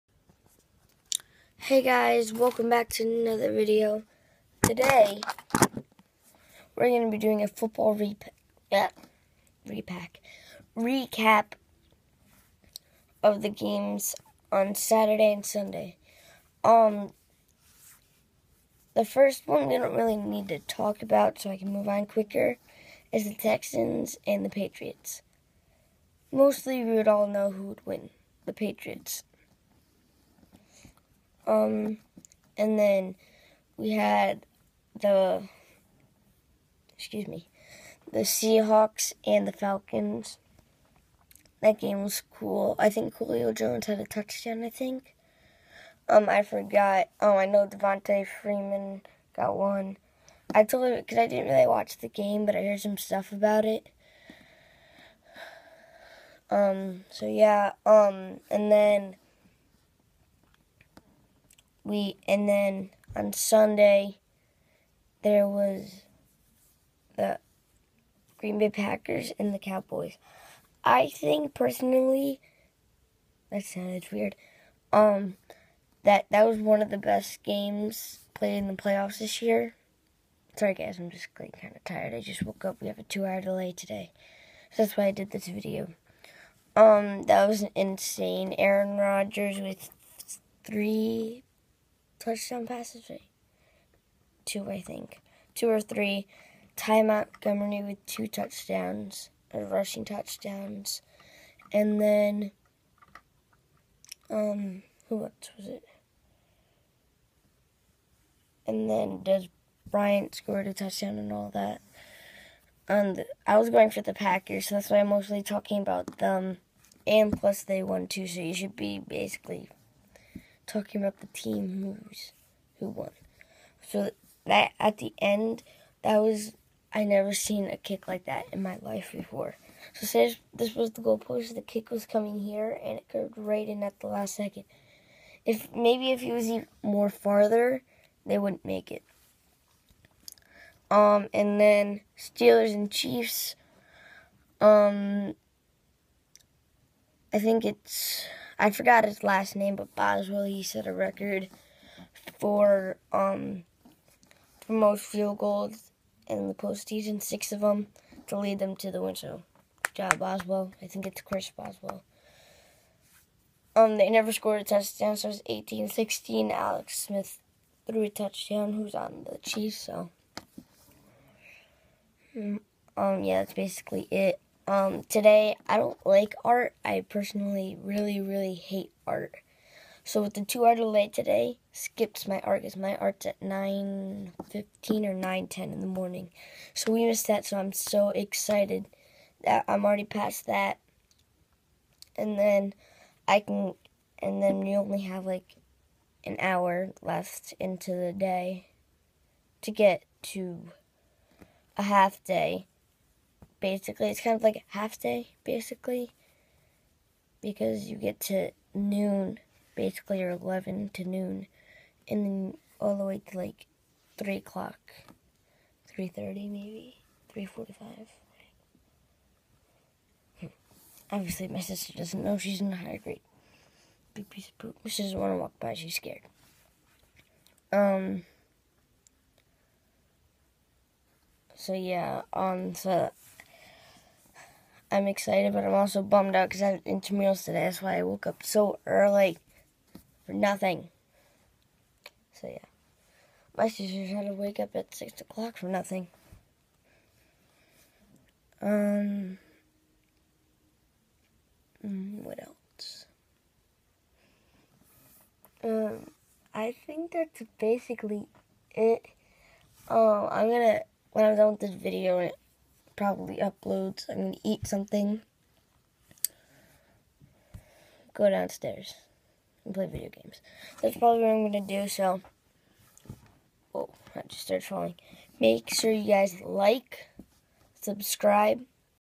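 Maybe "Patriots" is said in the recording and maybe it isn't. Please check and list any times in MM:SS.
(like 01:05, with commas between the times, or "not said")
00:24, 00:28.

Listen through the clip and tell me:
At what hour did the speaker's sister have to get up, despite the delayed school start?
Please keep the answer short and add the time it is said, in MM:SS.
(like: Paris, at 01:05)
6 o'clock, at 04:04.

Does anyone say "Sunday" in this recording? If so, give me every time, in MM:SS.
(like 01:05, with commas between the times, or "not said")
00:15, 01:03.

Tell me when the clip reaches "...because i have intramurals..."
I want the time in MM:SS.
03:56.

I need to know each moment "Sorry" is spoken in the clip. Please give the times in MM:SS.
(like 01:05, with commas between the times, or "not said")
01:20.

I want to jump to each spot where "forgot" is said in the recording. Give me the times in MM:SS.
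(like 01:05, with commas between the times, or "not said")
00:46, 02:28.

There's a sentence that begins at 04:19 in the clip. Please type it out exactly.
Um, I'm gonna when I'm done with this video probably upload.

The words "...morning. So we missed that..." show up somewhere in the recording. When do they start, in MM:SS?
03:05.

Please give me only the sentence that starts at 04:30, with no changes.
That's probably what I'm going to do.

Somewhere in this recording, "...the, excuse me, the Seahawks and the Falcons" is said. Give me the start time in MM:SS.
00:35.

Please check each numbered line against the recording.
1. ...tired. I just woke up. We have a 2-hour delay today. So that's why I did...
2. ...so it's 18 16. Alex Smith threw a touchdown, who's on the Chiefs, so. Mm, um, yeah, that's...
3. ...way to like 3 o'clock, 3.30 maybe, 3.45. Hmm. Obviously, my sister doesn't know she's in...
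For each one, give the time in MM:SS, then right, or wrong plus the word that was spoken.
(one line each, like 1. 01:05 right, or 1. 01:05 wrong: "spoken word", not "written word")
1. 01:21 right
2. 02:45 right
3. 03:33 right.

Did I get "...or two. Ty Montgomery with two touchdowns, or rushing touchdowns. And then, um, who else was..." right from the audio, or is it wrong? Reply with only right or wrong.
wrong.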